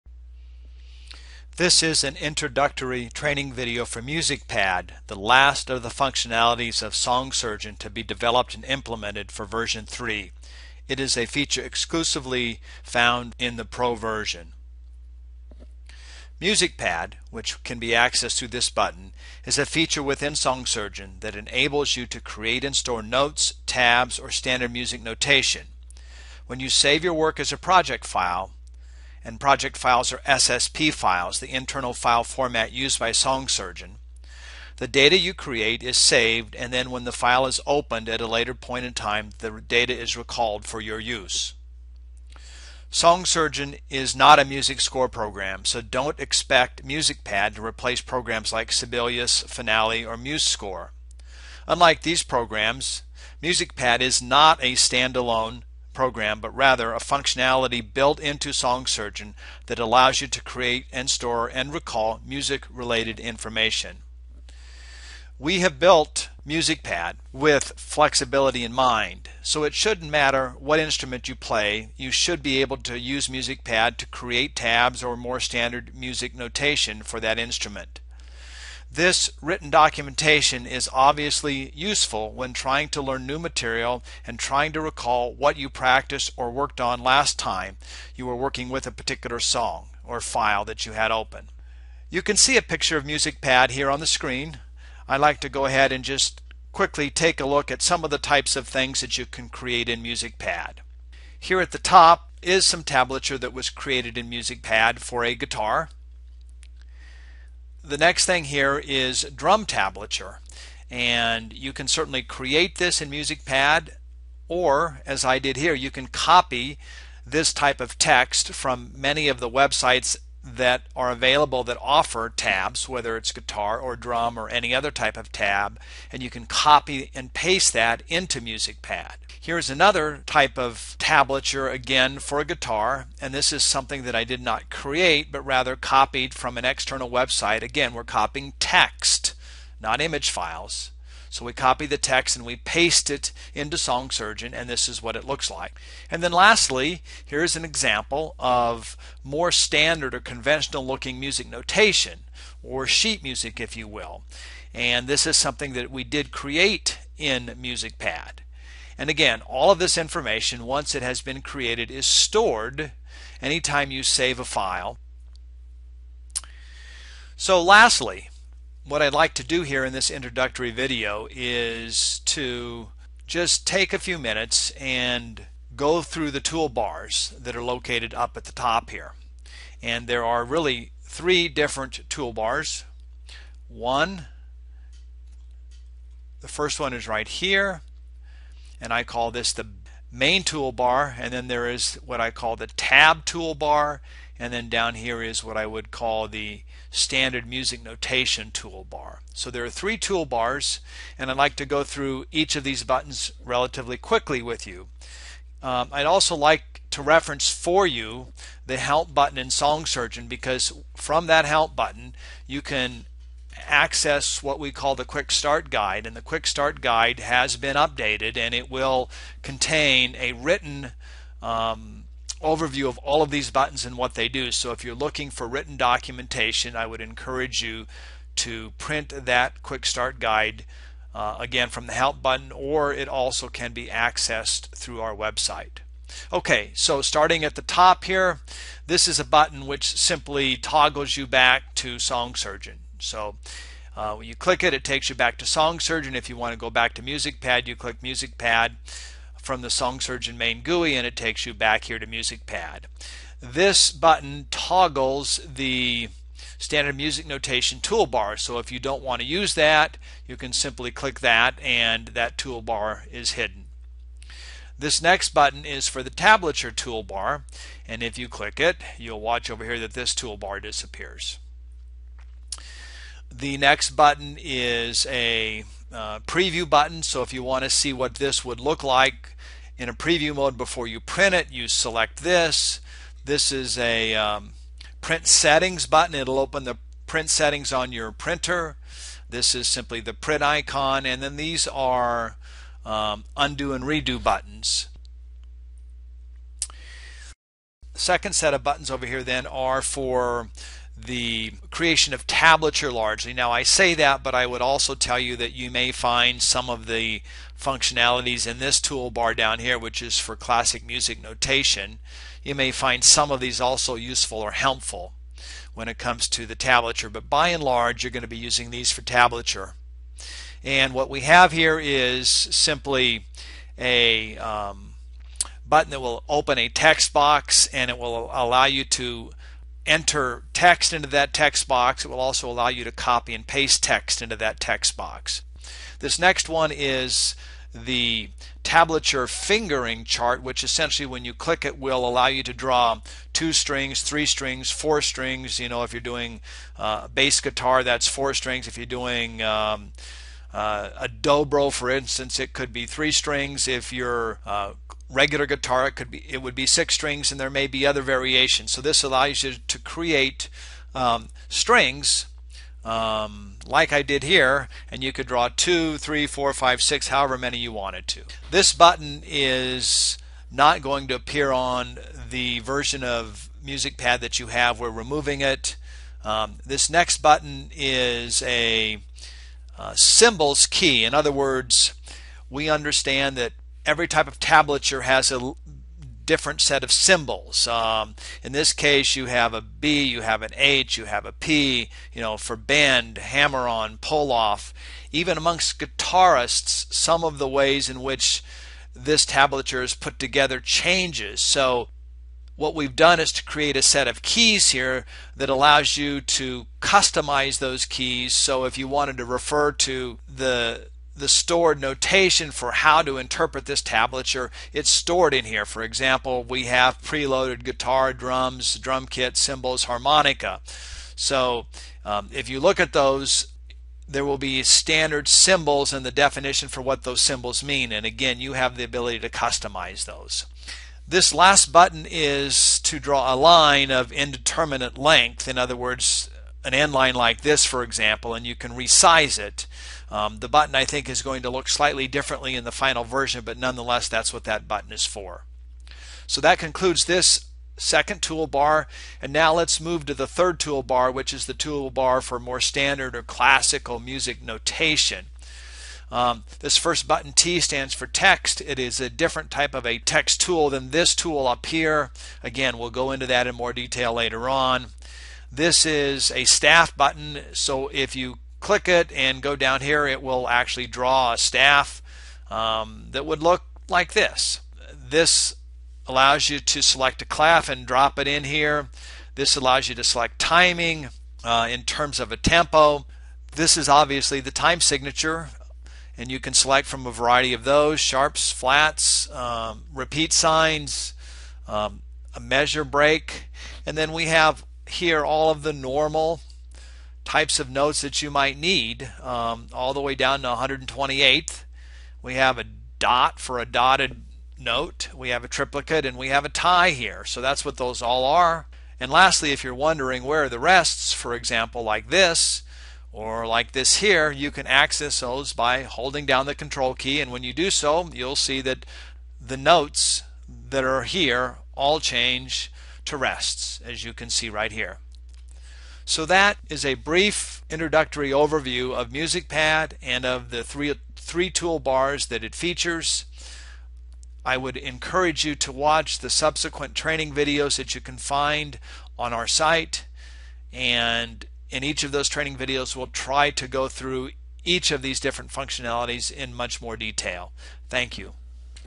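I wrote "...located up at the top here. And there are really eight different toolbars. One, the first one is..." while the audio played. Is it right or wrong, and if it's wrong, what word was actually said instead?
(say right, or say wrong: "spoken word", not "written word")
wrong: "three", not "eight".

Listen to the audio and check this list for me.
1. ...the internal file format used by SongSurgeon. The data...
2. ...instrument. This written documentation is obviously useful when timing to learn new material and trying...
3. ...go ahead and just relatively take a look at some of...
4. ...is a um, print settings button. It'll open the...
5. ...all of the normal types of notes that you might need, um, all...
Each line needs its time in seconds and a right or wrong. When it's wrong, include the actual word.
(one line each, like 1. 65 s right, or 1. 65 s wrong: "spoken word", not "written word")
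1. 31 s right
2. 77 s wrong: "trying", not "timing"
3. 95 s wrong: "quickly", not "relatively"
4. 283 s right
5. 495 s right.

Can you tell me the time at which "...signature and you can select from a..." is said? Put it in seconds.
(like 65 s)
484 s.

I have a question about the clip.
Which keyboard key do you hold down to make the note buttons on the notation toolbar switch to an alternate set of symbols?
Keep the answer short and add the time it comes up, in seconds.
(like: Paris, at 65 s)
control key, at 516 s.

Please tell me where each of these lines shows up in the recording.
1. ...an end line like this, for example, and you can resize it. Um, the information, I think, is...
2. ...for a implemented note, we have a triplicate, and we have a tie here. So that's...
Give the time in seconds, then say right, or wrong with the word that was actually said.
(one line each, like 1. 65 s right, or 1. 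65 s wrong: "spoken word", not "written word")
1. 436 s wrong: "button", not "information"
2. 503 s wrong: "dotted", not "implemented".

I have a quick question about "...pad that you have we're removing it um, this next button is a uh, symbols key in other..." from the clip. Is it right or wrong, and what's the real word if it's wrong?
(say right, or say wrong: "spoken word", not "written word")
right.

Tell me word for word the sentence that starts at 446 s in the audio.
So that concludes this second toolbar.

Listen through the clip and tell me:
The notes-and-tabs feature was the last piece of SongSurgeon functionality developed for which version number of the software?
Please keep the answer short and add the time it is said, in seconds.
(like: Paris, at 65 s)
3, at 9 s.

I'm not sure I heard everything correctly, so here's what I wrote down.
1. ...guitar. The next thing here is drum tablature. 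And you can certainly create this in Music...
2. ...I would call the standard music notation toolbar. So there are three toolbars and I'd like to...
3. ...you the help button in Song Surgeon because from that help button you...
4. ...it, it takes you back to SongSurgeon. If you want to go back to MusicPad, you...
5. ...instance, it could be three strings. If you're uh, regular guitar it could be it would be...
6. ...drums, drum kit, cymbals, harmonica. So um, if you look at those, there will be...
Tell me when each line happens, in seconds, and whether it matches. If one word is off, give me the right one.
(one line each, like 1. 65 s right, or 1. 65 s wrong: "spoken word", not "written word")
1. 105 s right
2. 195 s right
3. 207 s right
4. 244 s right
5. 351 s right
6. 418 s right.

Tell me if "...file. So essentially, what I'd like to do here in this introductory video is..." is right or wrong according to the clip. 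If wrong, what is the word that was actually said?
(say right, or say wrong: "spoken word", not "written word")
wrong: "lastly", not "essentially".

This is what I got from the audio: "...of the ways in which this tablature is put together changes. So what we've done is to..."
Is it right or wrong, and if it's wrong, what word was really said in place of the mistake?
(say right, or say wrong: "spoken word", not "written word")
right.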